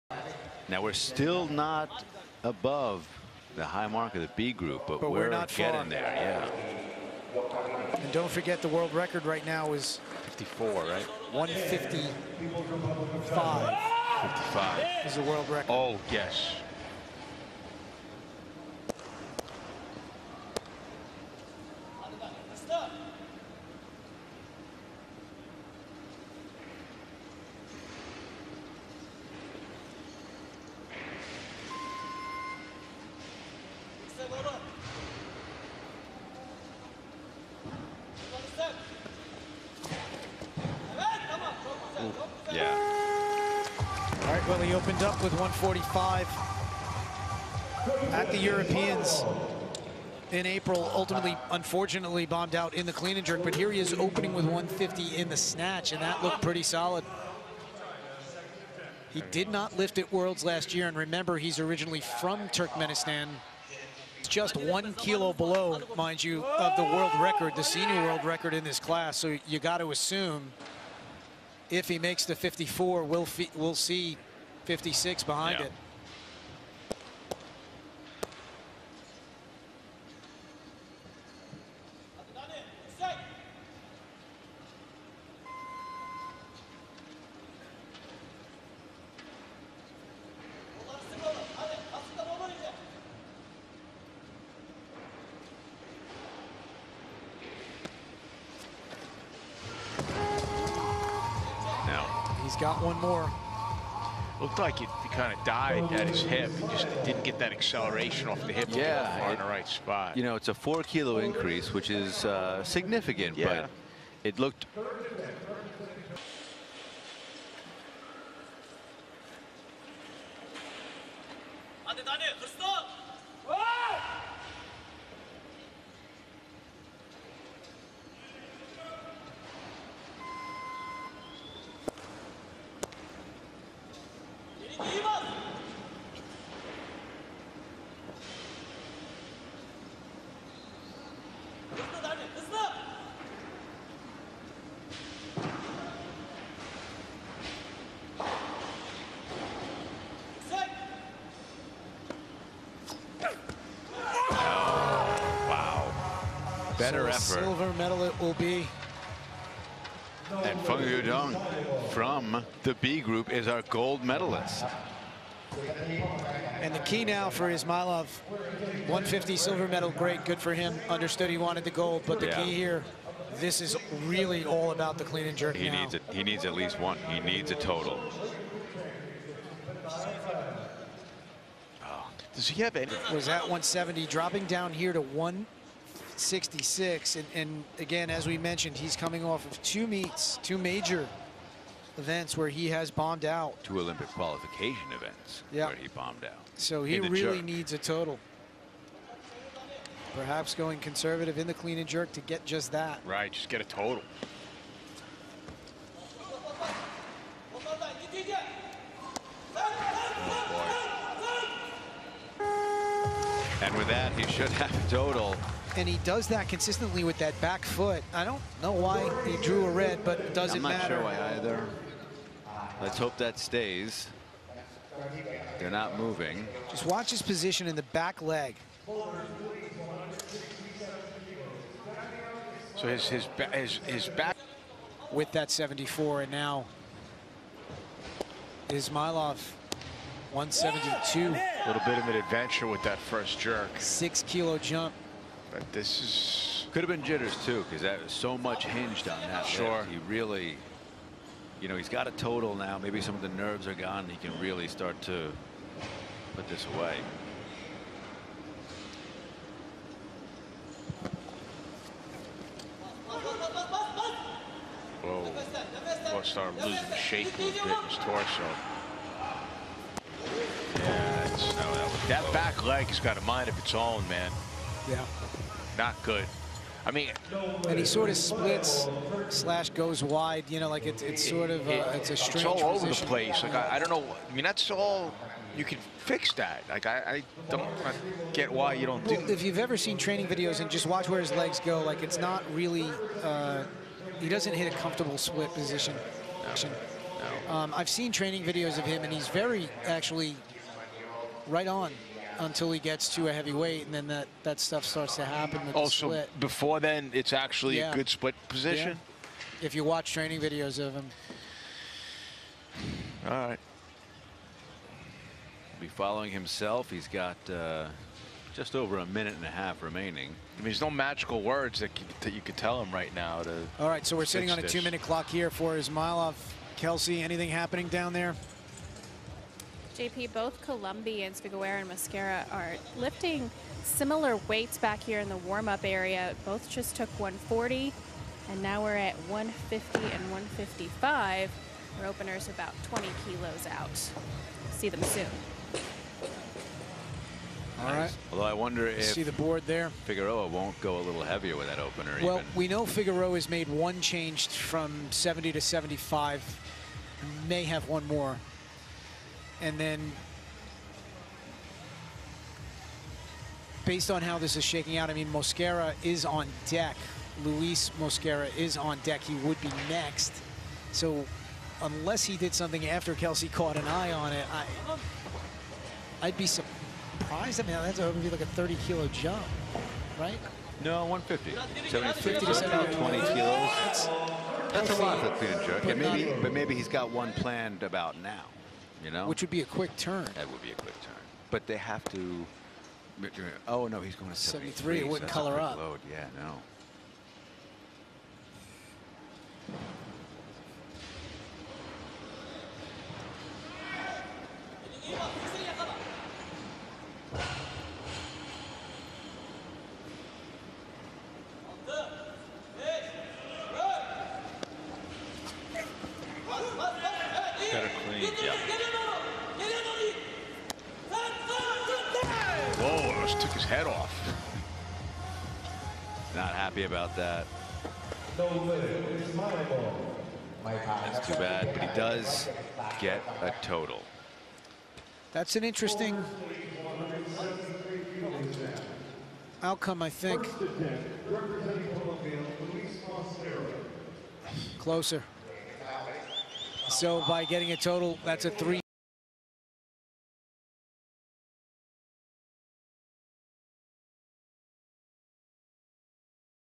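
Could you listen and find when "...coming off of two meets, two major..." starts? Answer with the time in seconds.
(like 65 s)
188 s.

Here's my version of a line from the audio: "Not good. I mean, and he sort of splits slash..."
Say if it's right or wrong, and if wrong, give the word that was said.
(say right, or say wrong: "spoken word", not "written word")
right.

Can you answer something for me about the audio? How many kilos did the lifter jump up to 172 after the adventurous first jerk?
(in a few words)
6 kilos.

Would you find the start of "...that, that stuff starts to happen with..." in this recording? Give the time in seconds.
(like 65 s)
304 s.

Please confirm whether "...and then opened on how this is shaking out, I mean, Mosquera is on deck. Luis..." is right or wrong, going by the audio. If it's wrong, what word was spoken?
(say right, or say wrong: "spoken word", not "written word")
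wrong: "based", not "opened".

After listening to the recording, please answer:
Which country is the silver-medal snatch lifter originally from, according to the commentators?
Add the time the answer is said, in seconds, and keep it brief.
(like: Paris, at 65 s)
Turkmenistan, at 62 s.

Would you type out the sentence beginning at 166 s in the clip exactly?
And the key now for İsmayilov, 150 silver medal, great, good for him.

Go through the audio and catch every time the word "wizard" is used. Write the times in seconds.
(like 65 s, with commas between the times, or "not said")
not said.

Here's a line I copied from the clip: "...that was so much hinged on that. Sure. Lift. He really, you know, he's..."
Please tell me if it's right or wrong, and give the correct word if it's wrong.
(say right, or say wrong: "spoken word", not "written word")
right.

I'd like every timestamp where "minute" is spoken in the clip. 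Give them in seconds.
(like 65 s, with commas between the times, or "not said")
319 s, 324 s.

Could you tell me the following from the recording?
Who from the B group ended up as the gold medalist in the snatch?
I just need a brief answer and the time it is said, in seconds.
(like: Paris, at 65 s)
Feng Lüdong, at 160 s.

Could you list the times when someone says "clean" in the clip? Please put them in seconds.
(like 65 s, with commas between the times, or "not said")
52 s, 175 s, 201 s, 418 s.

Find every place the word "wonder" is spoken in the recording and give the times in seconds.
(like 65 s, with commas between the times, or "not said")
348 s.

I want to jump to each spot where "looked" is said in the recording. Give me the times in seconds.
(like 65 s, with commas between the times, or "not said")
56 s, 104 s, 114 s.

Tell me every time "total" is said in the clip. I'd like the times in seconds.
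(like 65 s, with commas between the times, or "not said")
177 s, 197 s, 203 s, 214 s, 252 s, 433 s, 447 s.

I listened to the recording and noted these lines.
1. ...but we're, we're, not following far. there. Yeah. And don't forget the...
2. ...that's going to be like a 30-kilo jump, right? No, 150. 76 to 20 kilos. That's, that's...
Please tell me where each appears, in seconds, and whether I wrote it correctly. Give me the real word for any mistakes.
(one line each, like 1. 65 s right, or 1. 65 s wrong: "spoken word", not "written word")
1. 5 s wrong: "getting", not "following"
2. 377 s right.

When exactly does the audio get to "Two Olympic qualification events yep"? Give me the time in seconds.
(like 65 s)
193 s.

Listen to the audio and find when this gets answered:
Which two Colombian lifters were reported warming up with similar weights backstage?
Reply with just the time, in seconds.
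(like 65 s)
331 s.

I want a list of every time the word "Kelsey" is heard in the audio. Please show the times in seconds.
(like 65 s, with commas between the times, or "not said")
326 s, 373 s.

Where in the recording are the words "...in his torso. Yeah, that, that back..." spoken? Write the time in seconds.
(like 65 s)
267 s.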